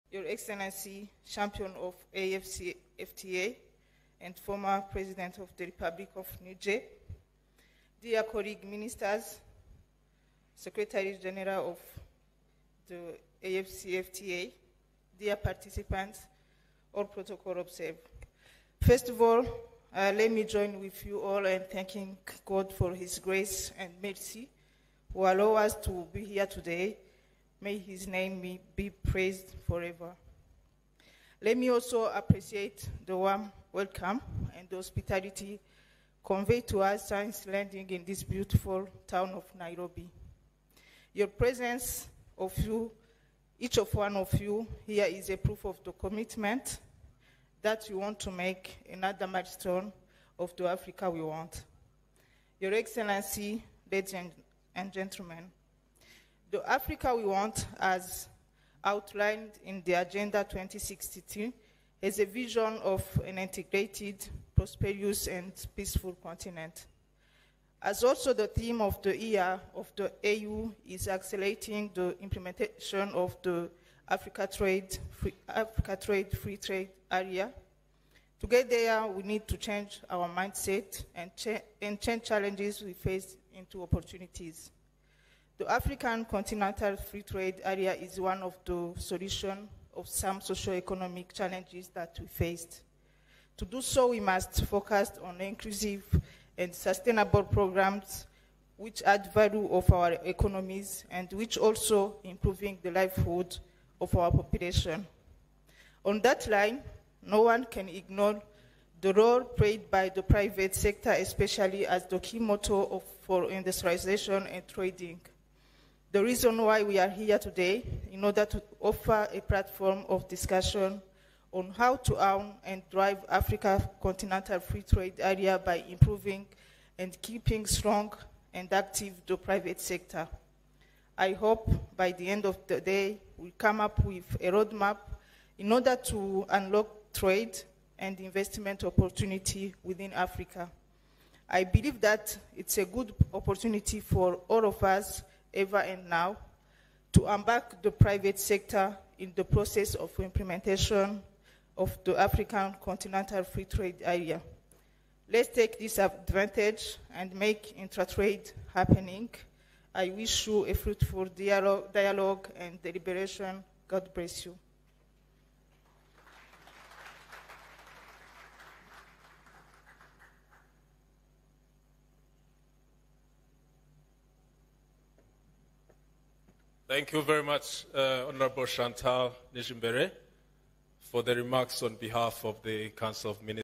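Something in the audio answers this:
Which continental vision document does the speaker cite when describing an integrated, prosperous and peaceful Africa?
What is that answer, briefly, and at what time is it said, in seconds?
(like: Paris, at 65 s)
Agenda 2062, at 59 s.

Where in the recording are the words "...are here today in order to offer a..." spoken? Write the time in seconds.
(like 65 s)
116 s.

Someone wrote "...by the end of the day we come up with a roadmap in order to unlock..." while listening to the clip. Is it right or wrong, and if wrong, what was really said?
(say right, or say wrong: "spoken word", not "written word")
right.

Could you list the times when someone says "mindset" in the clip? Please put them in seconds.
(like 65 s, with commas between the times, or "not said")
80 s.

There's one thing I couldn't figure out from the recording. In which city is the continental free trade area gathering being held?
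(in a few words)
Nairobi.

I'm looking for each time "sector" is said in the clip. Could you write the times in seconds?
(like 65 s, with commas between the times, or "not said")
110 s, 129 s, 148 s.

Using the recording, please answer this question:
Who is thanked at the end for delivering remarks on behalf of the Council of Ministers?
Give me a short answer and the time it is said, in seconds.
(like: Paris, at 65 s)
Chantal Nijimbere, at 178 s.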